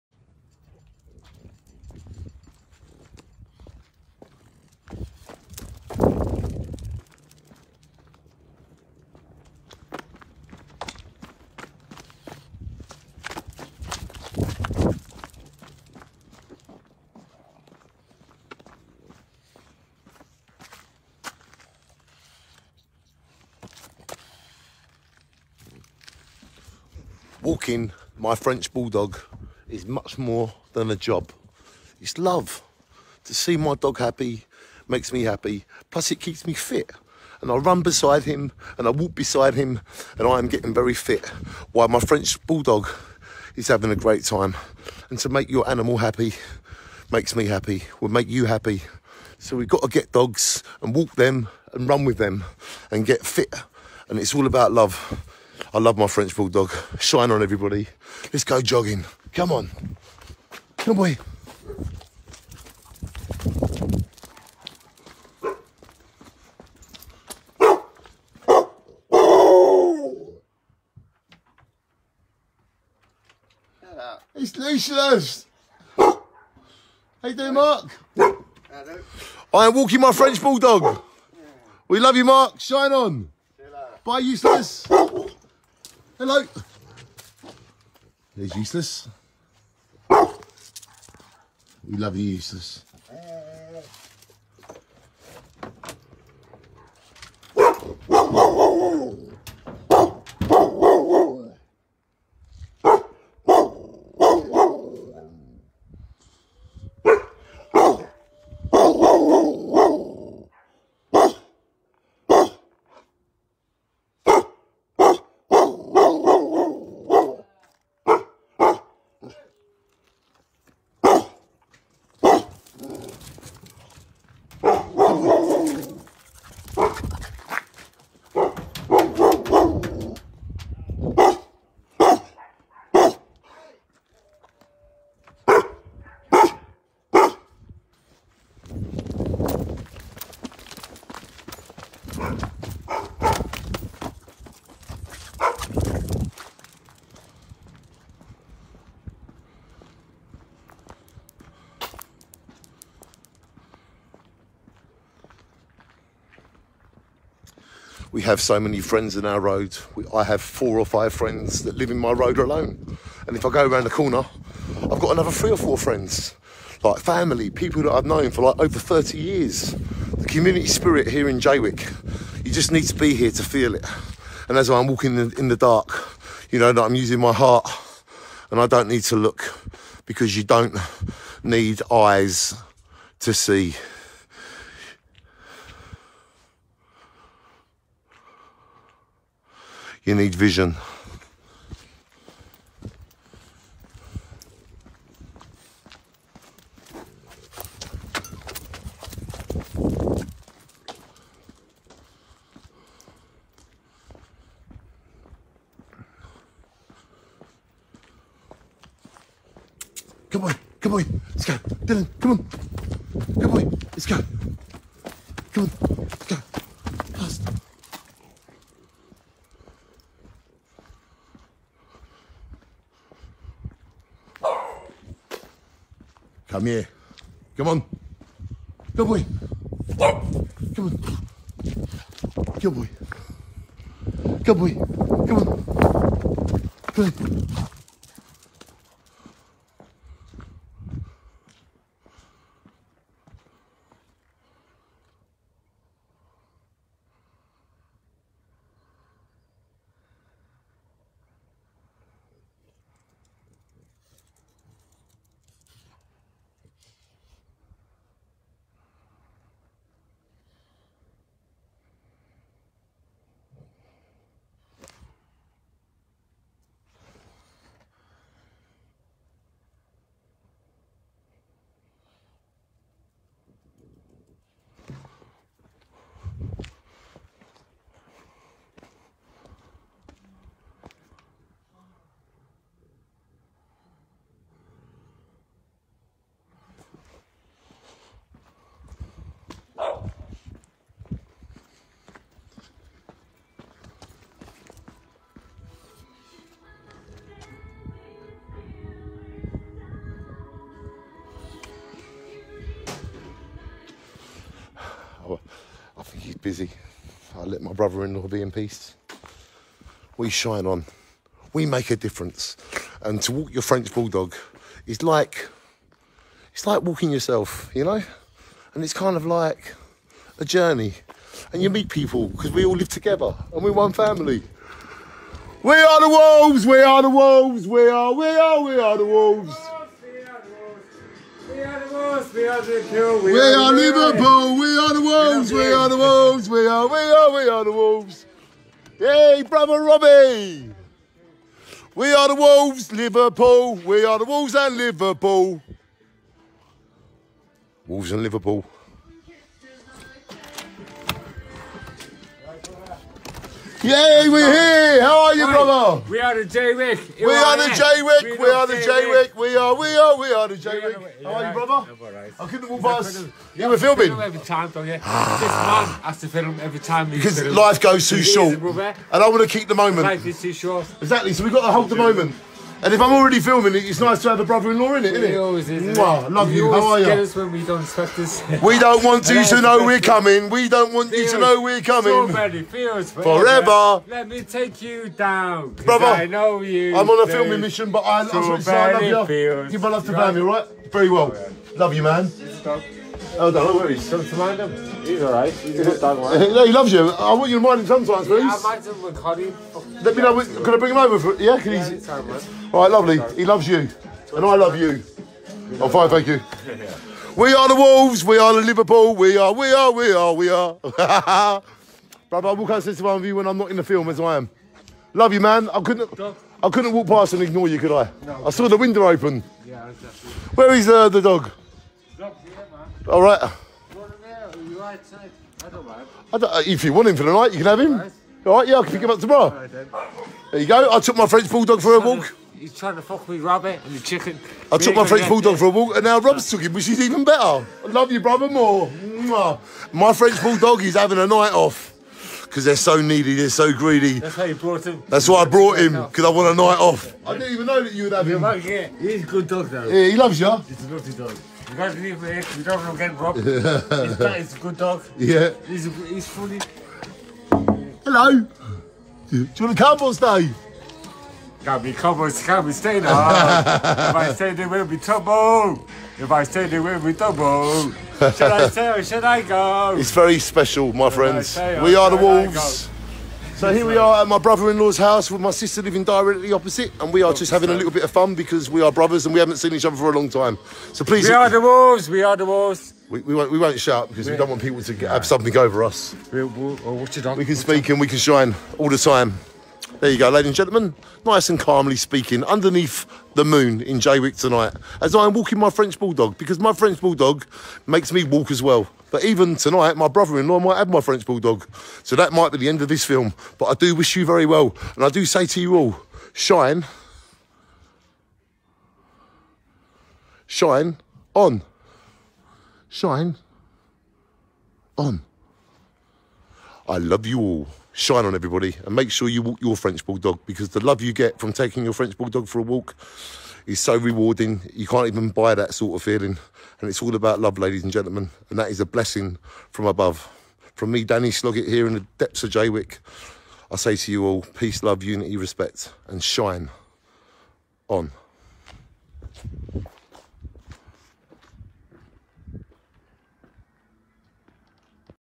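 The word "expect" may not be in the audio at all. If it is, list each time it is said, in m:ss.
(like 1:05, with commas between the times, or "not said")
6:17.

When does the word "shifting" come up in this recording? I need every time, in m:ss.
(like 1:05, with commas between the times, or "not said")
not said.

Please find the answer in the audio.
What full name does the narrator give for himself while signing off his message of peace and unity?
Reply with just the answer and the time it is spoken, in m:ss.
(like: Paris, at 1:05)
Danny Sloggett, at 8:51.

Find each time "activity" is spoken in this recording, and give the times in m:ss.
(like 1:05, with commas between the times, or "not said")
not said.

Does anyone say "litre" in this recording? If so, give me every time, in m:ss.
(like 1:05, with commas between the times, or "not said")
not said.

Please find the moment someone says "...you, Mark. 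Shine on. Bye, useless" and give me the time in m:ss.
1:22.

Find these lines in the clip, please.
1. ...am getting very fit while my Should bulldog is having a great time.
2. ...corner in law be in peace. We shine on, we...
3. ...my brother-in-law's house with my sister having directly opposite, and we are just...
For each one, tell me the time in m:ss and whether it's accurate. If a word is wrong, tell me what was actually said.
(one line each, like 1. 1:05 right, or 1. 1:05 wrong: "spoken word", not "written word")
1. 0:40 wrong: "French", not "Should"
2. 5:07 wrong: "brother", not "corner"
3. 7:54 wrong: "living", not "having".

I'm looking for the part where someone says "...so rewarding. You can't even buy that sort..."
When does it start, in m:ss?
8:43.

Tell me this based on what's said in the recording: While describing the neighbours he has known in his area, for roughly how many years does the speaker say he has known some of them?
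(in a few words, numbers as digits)
over 30 years.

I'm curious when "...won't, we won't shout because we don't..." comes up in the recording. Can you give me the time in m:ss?
8:03.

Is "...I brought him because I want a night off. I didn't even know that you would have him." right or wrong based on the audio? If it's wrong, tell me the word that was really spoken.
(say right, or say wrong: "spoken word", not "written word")
right.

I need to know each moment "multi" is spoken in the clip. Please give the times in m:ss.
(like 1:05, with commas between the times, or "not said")
not said.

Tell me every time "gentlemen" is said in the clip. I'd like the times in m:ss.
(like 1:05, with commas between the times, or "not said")
8:10, 8:47.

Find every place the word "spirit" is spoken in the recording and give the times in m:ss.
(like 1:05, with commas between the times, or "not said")
2:50.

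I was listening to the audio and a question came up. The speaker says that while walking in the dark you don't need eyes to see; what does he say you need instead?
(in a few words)
vision.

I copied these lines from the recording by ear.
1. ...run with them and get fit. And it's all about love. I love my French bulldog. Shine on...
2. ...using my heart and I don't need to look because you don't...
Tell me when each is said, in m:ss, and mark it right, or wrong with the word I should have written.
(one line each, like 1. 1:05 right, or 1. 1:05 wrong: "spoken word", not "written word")
1. 0:51 right
2. 2:56 right.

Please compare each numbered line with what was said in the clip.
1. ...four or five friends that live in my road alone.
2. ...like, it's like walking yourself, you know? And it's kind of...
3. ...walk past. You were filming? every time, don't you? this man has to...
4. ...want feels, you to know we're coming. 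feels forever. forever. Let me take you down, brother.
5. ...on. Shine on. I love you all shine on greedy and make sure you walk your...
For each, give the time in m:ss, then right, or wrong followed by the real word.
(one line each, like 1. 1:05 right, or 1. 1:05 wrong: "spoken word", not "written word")
1. 2:40 right
2. 5:15 right
3. 6:02 right
4. 6:20 right
5. 8:31 wrong: "everybody", not "greedy".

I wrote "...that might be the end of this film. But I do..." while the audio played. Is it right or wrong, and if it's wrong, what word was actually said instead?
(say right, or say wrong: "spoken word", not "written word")
right.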